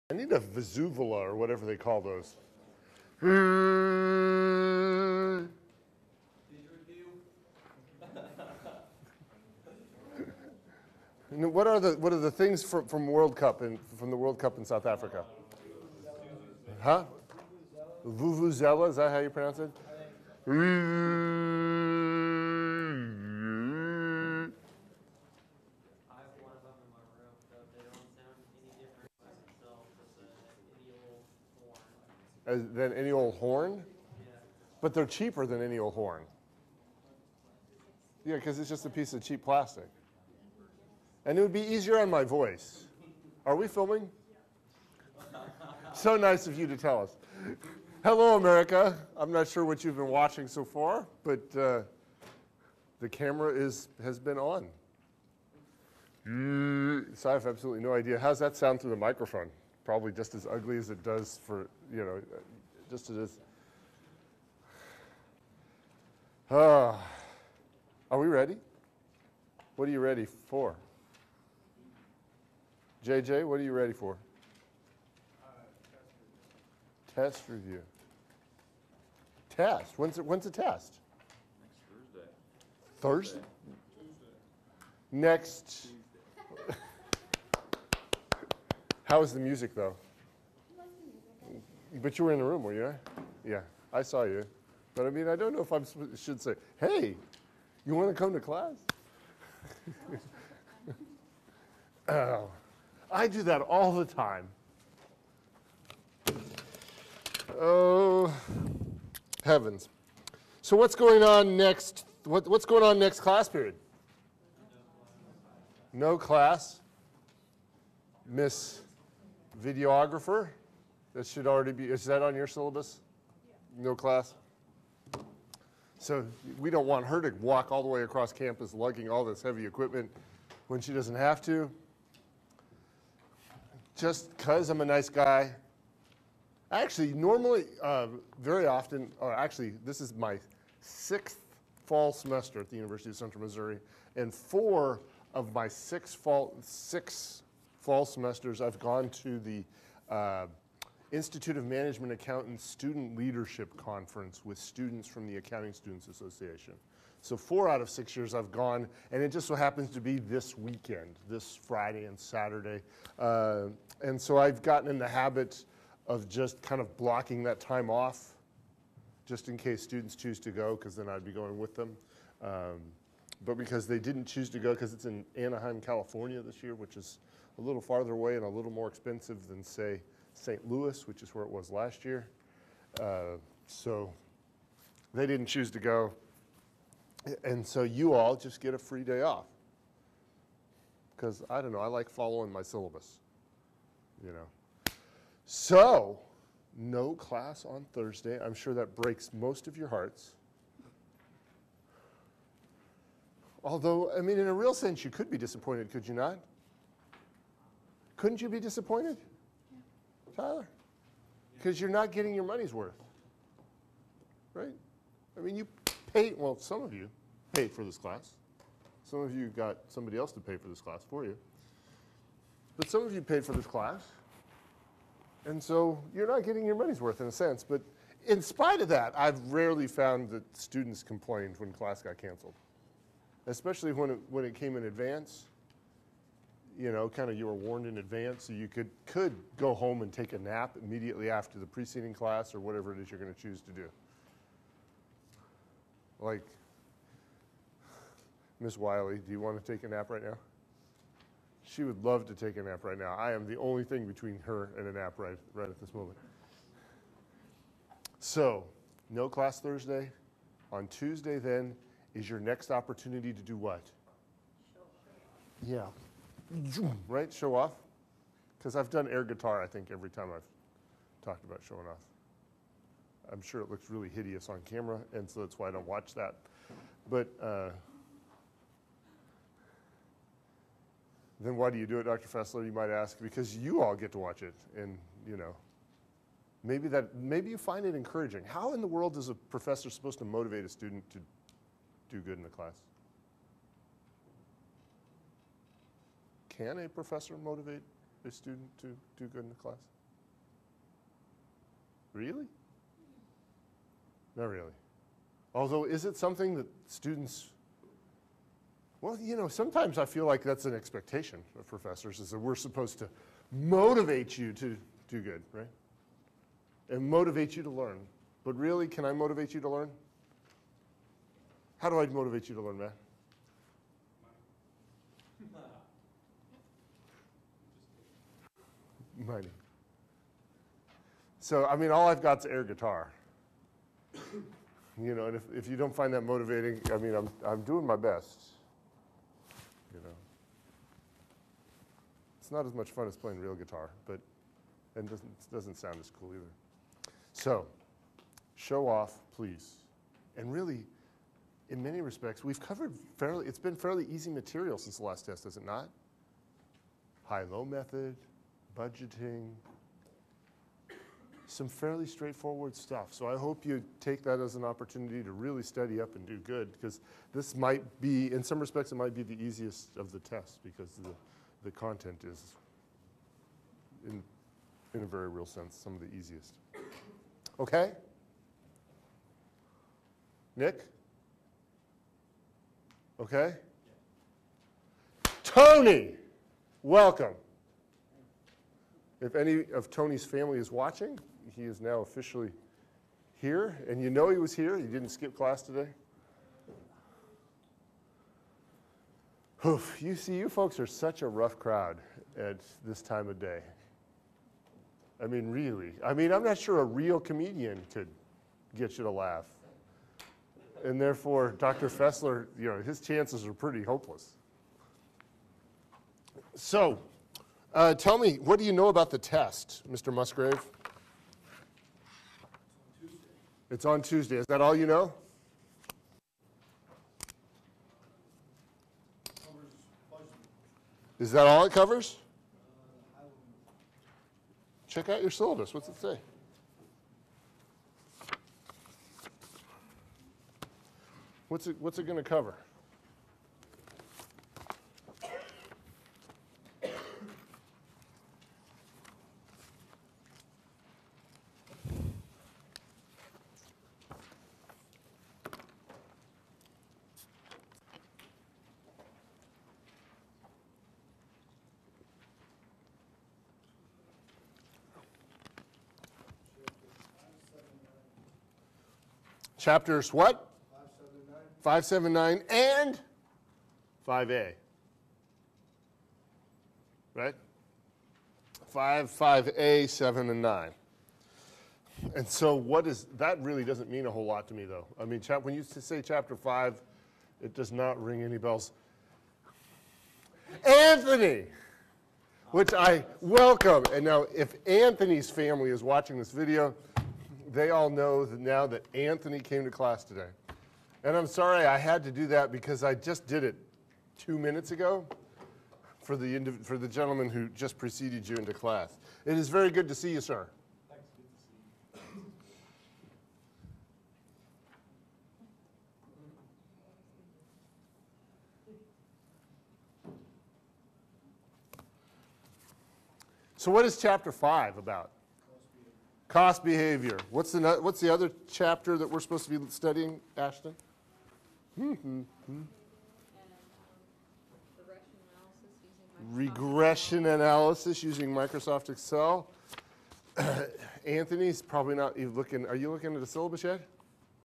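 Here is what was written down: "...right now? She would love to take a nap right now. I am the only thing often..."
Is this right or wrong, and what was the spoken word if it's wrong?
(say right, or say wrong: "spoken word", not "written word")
wrong: "between", not "often".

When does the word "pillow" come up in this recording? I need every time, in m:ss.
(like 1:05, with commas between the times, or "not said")
not said.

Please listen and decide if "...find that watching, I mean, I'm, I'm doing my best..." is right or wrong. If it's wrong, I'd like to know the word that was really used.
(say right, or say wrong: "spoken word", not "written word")
wrong: "motivating", not "watching".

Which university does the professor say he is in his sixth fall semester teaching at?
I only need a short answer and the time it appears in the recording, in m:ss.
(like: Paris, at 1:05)
University of Central Missouri, at 2:22.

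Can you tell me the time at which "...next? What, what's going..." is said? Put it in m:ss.
1:51.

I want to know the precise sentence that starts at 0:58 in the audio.
How's that sound through the microphone?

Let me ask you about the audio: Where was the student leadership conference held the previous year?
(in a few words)
St. Louis.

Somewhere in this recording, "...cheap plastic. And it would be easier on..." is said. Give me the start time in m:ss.
0:39.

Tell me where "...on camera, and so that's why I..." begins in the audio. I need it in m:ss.
4:34.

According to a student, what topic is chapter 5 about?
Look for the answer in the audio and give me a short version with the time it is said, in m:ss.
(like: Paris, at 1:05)
Cost behavior, at 8:46.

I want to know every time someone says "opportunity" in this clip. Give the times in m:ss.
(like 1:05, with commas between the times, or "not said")
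4:22, 6:04.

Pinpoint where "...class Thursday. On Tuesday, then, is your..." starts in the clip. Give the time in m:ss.
4:19.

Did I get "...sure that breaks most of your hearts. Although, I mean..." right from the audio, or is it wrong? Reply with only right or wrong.
right.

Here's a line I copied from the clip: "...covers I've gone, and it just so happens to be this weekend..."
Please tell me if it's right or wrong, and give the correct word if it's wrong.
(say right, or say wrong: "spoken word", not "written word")
wrong: "years", not "covers".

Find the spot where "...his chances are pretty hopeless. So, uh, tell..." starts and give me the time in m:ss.
6:52.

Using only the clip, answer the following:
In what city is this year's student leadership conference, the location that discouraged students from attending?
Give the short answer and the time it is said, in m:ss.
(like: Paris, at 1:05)
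Anaheim, California, at 2:55.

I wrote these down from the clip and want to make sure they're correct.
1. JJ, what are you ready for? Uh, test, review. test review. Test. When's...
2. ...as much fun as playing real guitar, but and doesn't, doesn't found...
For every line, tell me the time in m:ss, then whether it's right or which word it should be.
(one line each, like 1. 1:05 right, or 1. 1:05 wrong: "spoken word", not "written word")
1. 1:13 right
2. 5:42 wrong: "sound", not "found".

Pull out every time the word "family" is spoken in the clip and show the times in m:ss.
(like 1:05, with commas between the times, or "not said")
6:30, 8:15.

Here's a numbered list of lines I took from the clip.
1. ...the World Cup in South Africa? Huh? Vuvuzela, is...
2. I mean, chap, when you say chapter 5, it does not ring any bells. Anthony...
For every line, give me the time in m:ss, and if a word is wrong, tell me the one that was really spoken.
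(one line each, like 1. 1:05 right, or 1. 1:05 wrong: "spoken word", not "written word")
1. 0:14 right
2. 8:04 right.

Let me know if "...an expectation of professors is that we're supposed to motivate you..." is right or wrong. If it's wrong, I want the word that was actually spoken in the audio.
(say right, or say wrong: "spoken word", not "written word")
right.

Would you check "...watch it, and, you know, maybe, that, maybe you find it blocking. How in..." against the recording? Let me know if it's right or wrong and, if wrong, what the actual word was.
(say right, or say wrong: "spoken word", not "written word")
wrong: "encouraging", not "blocking".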